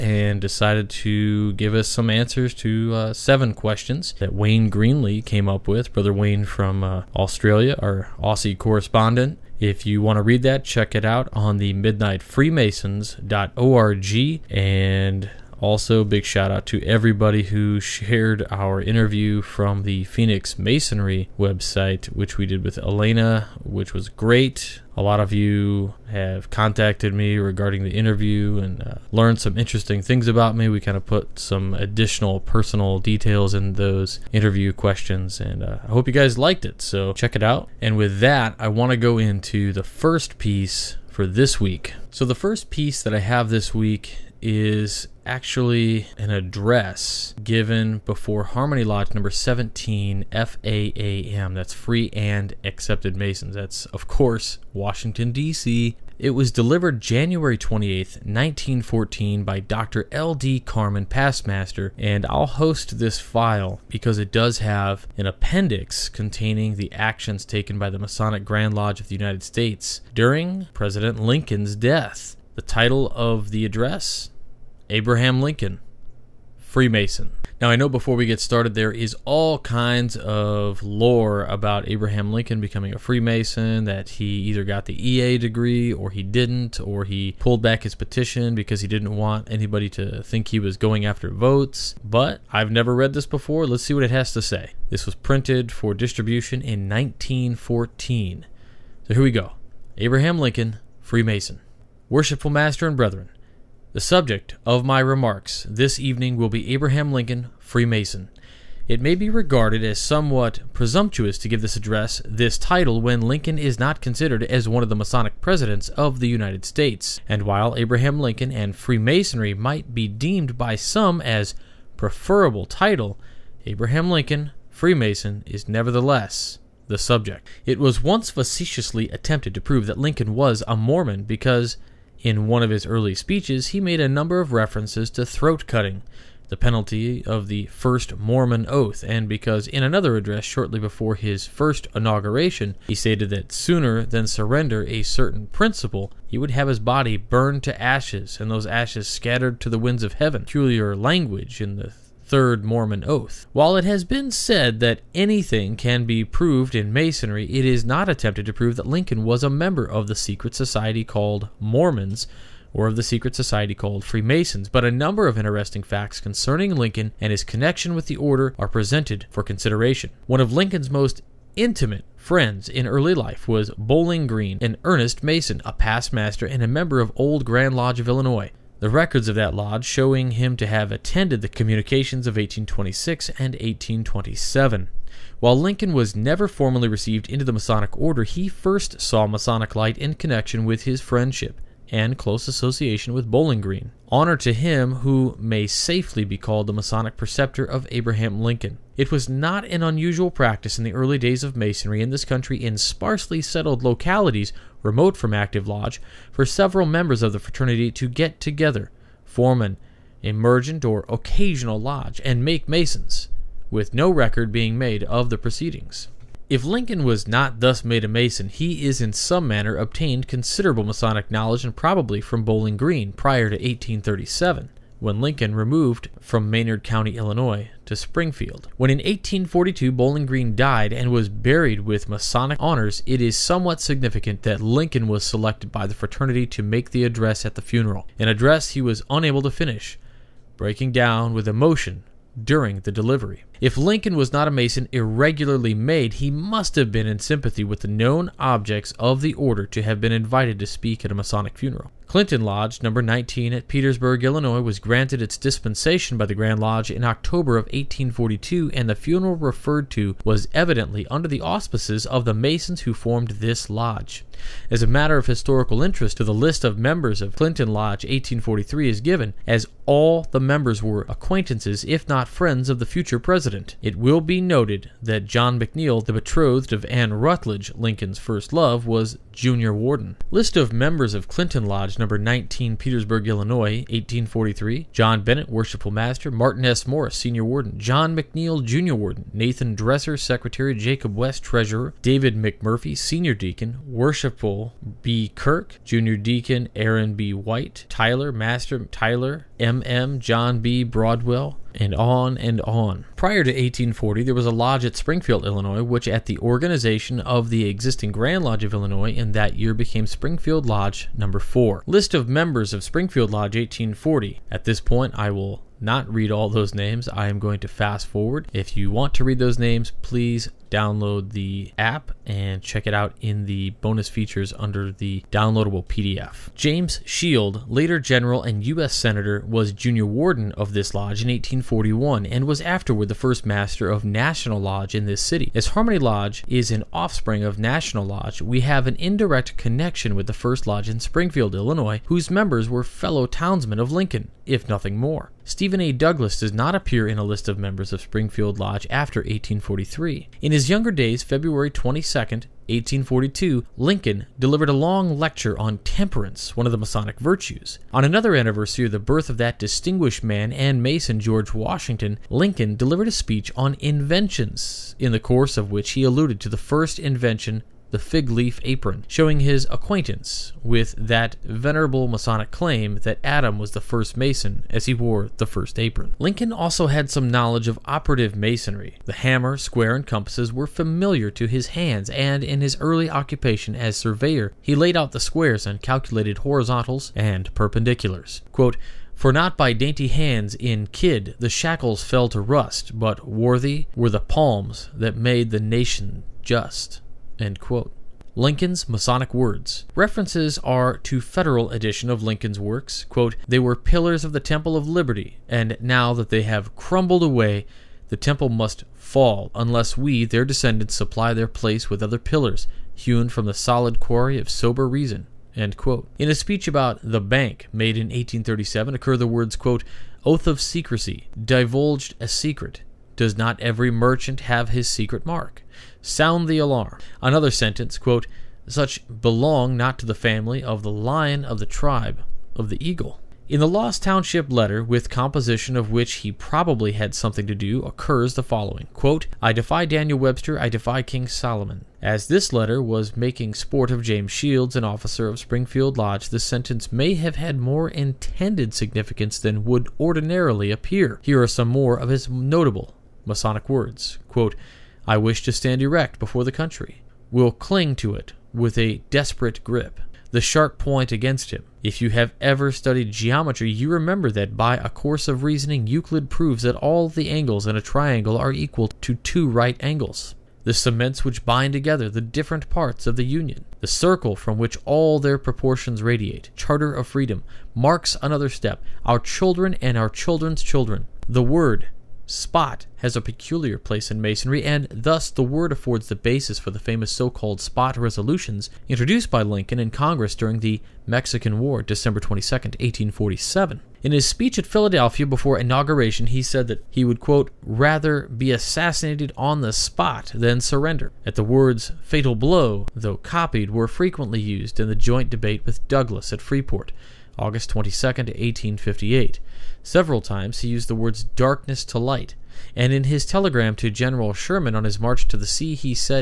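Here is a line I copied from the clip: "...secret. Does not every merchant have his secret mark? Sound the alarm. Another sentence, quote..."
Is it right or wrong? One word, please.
right.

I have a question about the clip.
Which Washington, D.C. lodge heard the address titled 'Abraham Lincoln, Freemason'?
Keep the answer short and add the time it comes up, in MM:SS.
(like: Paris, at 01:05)
Harmony Lodge No. 17, at 00:48.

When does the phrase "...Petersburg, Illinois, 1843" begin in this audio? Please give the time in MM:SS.
04:42.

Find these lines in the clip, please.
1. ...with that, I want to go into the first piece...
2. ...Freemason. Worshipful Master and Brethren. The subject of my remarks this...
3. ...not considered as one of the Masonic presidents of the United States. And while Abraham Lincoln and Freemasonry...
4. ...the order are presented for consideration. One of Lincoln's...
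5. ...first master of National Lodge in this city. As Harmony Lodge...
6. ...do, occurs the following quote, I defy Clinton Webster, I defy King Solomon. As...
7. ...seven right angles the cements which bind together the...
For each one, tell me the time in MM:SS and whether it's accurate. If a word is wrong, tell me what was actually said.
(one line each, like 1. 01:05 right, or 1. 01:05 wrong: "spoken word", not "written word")
1. 00:37 right
2. 01:40 right
3. 01:53 right
4. 02:48 right
5. 05:33 right
6. 07:17 wrong: "Daniel", not "Clinton"
7. 07:49 wrong: "two", not "seven".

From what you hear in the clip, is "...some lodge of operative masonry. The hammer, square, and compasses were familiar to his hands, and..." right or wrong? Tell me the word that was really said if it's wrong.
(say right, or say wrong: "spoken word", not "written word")
wrong: "knowledge", not "lodge".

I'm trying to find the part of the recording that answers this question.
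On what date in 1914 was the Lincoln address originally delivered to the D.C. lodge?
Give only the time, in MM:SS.
00:56.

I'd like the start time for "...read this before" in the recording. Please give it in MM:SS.
01:32.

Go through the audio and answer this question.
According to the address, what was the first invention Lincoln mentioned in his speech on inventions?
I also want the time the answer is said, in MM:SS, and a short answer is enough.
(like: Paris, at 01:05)
the fig leaf apron, at 06:07.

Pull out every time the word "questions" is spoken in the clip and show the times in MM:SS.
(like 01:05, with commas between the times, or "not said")
00:03, 00:34.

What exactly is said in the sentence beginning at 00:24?
A lot of you have contacted me regarding the interview and uh, learned some interesting things about me.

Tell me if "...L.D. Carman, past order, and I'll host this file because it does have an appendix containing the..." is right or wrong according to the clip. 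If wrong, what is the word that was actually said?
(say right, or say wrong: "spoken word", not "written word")
wrong: "master", not "order".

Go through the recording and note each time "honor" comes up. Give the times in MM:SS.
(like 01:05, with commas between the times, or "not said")
03:14, 03:52.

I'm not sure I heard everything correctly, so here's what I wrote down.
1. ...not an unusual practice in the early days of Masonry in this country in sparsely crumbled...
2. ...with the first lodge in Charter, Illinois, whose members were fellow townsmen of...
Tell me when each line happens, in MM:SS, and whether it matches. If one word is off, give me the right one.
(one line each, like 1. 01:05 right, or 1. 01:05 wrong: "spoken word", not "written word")
1. 03:19 wrong: "settled", not "crumbled"
2. 05:40 wrong: "Springfield", not "Charter".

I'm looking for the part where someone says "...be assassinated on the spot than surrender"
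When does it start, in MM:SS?
08:18.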